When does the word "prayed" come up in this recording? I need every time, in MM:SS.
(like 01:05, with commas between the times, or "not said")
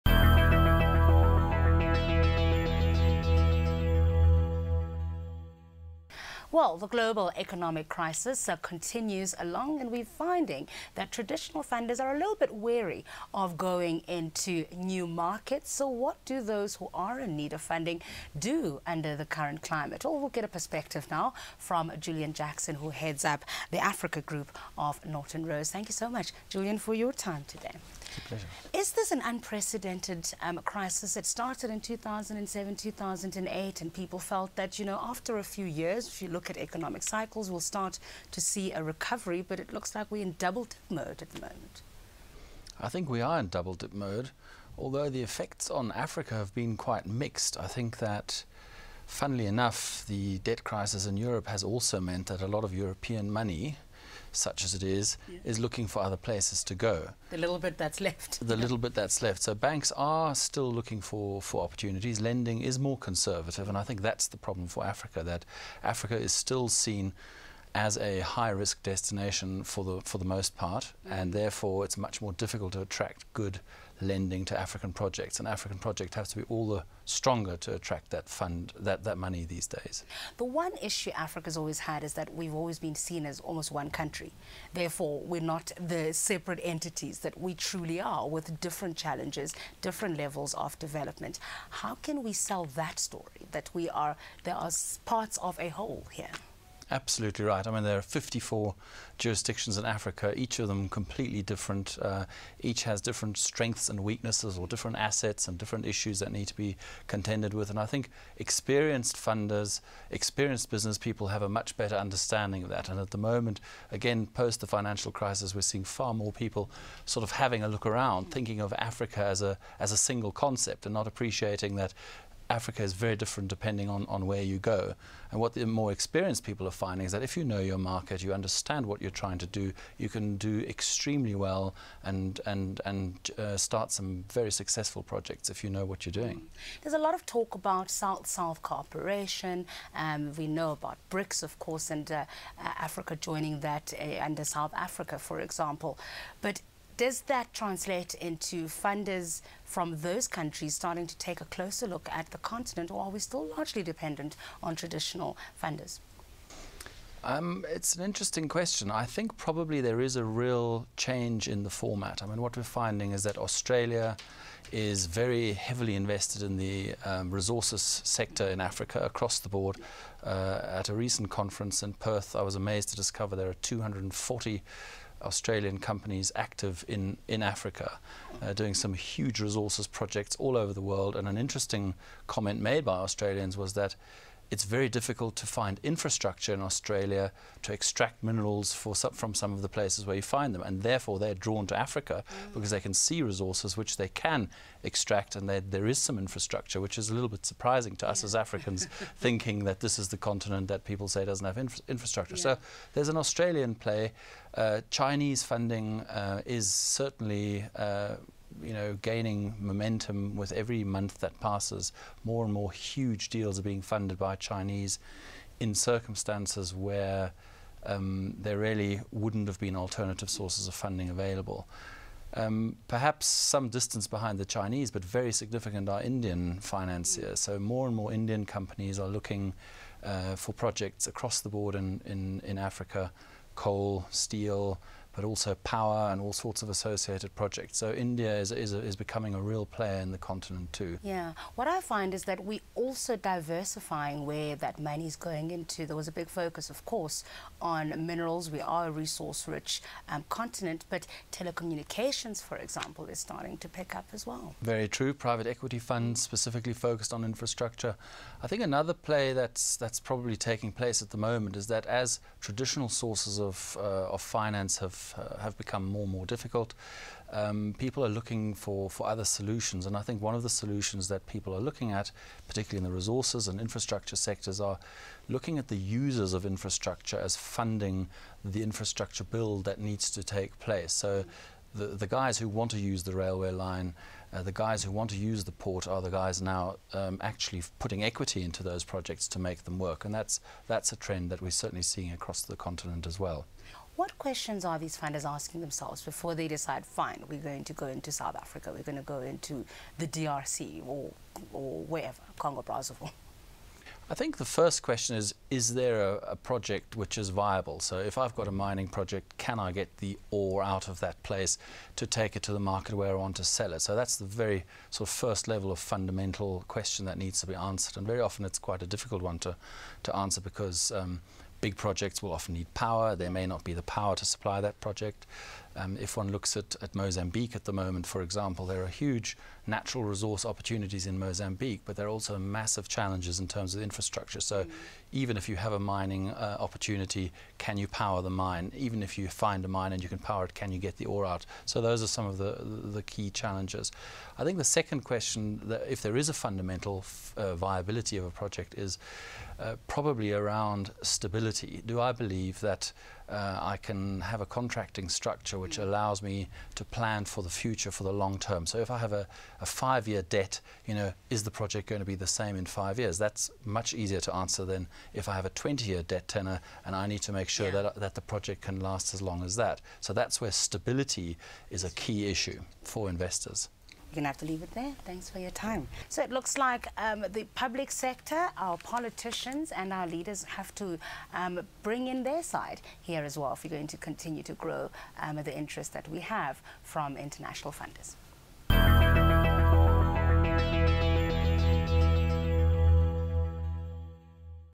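not said.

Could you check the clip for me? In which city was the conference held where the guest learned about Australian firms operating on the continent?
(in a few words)
Perth.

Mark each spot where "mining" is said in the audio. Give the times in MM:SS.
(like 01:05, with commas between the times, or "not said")
05:08, 05:35.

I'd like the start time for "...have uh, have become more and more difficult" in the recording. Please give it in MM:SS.
04:25.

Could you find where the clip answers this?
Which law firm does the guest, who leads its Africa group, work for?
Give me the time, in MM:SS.
00:25.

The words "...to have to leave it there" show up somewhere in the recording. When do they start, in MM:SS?
06:14.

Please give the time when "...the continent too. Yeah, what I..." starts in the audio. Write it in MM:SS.
04:00.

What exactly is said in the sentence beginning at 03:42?
Um, perhaps some distance behind the Chinese, but very significant are Indian financiers.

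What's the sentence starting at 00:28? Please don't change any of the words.
Is this an unprecedented um, crisis?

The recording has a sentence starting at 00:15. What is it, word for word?
So, what do those who are in need of funding do under the current climate?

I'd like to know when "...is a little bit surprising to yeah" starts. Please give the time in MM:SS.
03:16.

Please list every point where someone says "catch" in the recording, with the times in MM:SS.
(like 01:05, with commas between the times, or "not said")
not said.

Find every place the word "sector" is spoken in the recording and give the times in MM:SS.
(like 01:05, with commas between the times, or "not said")
02:48, 04:34, 06:17.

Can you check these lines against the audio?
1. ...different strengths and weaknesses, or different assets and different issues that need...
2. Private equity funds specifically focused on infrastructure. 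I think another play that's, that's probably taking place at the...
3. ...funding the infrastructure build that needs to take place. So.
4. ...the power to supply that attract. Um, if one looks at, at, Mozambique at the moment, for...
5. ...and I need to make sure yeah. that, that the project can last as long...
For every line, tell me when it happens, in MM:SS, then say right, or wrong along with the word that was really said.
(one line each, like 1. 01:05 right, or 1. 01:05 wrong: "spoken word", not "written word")
1. 01:43 right
2. 04:15 right
3. 04:37 right
4. 05:23 wrong: "project", not "attract"
5. 06:06 right.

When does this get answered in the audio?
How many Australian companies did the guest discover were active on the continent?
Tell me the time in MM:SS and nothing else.
02:53.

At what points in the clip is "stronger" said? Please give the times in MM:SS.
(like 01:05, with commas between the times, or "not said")
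01:17.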